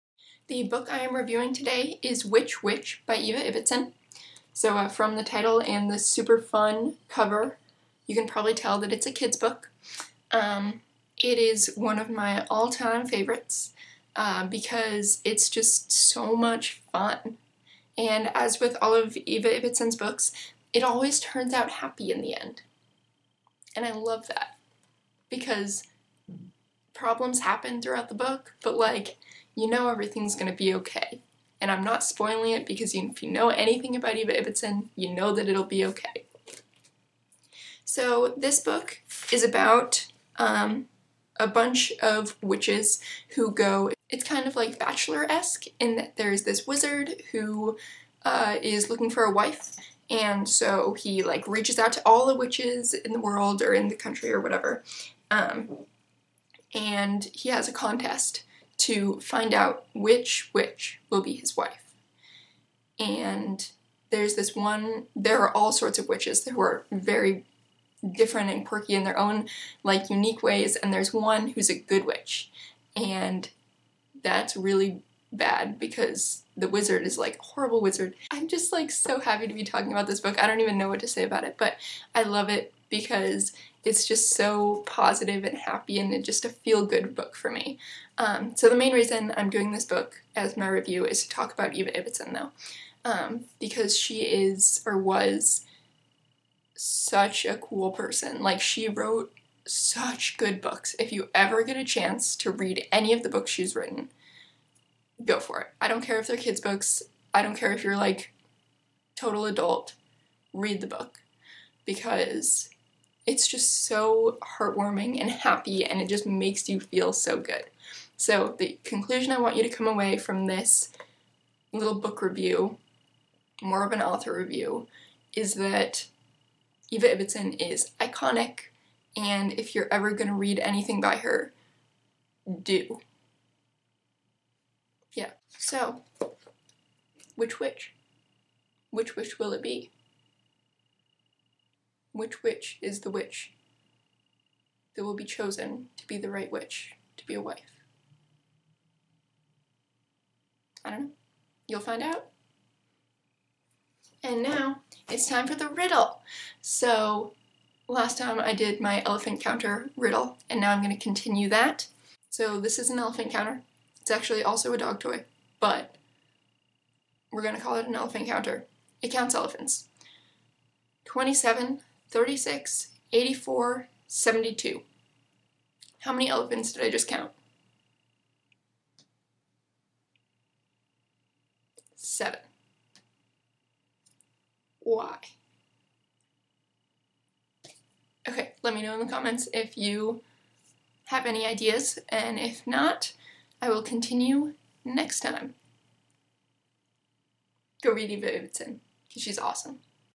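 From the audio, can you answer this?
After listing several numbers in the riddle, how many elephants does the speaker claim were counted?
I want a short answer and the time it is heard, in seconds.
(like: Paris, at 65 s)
7, at 181 s.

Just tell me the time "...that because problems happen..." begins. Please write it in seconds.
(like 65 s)
24 s.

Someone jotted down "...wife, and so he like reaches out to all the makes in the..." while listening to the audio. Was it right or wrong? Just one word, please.
wrong.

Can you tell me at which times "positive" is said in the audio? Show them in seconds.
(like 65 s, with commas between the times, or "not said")
84 s.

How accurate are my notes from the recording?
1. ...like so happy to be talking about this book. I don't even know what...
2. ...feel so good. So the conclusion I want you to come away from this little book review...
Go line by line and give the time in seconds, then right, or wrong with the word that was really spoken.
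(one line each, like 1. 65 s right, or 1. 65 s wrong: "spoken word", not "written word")
1. 78 s right
2. 116 s right.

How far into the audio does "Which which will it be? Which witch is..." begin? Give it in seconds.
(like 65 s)
138 s.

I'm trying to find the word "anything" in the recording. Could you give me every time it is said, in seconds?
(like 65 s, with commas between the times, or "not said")
33 s, 130 s.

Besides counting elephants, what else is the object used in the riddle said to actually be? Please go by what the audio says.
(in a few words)
A dog toy.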